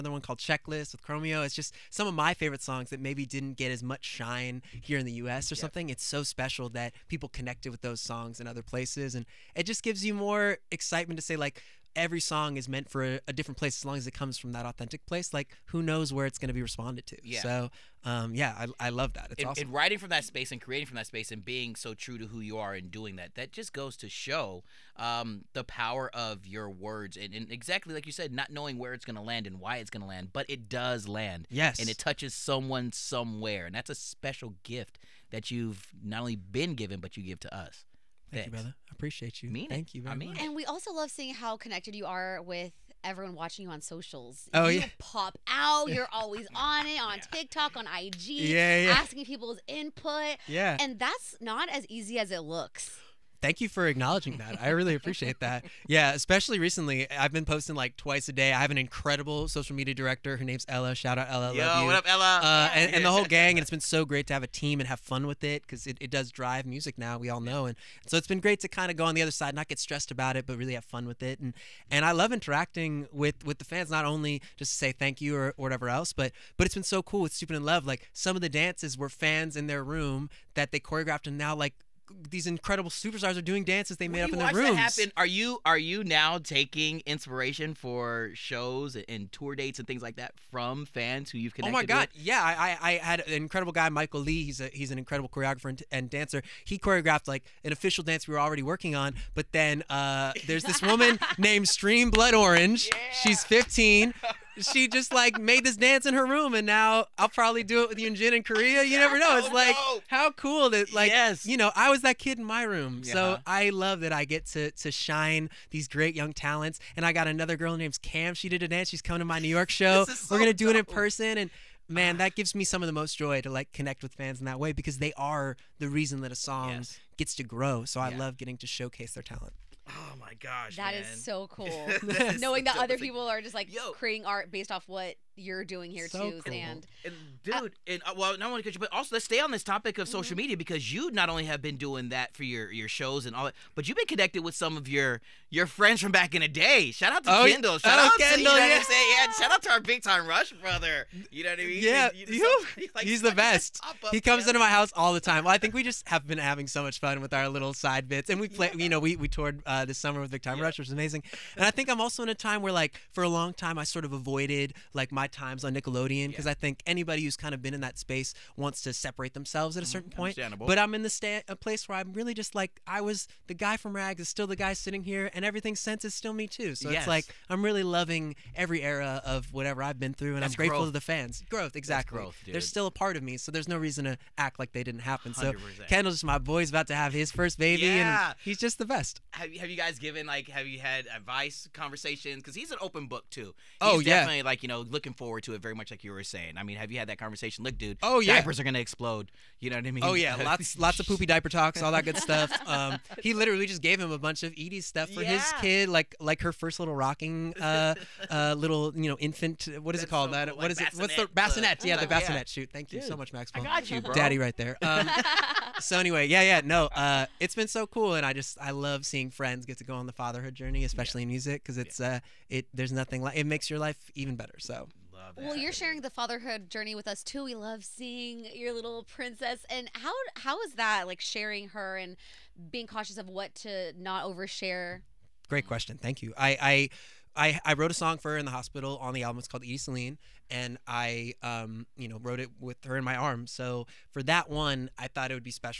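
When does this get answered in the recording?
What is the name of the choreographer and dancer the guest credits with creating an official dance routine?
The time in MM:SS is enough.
01:33.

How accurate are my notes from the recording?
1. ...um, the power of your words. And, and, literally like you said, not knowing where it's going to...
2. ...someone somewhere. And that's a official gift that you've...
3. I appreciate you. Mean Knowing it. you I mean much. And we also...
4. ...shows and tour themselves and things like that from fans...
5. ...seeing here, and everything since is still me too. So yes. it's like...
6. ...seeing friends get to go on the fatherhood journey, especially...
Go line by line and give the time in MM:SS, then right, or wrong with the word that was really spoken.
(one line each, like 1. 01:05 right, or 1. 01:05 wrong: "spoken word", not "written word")
1. 00:24 wrong: "exactly", not "literally"
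2. 00:32 wrong: "special", not "official"
3. 00:38 wrong: "Thank", not "Knowing"
4. 01:28 wrong: "dates", not "themselves"
5. 02:54 wrong: "sitting", not "seeing"
6. 03:39 right.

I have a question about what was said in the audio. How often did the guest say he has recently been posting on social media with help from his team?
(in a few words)
Twice a day.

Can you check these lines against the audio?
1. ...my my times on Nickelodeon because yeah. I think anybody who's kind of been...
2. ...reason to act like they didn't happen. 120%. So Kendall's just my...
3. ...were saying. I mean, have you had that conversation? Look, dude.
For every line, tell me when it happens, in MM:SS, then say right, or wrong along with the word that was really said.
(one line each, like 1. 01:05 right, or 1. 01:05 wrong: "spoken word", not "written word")
1. 02:45 right
2. 03:03 wrong: "100", not "120"
3. 03:16 right.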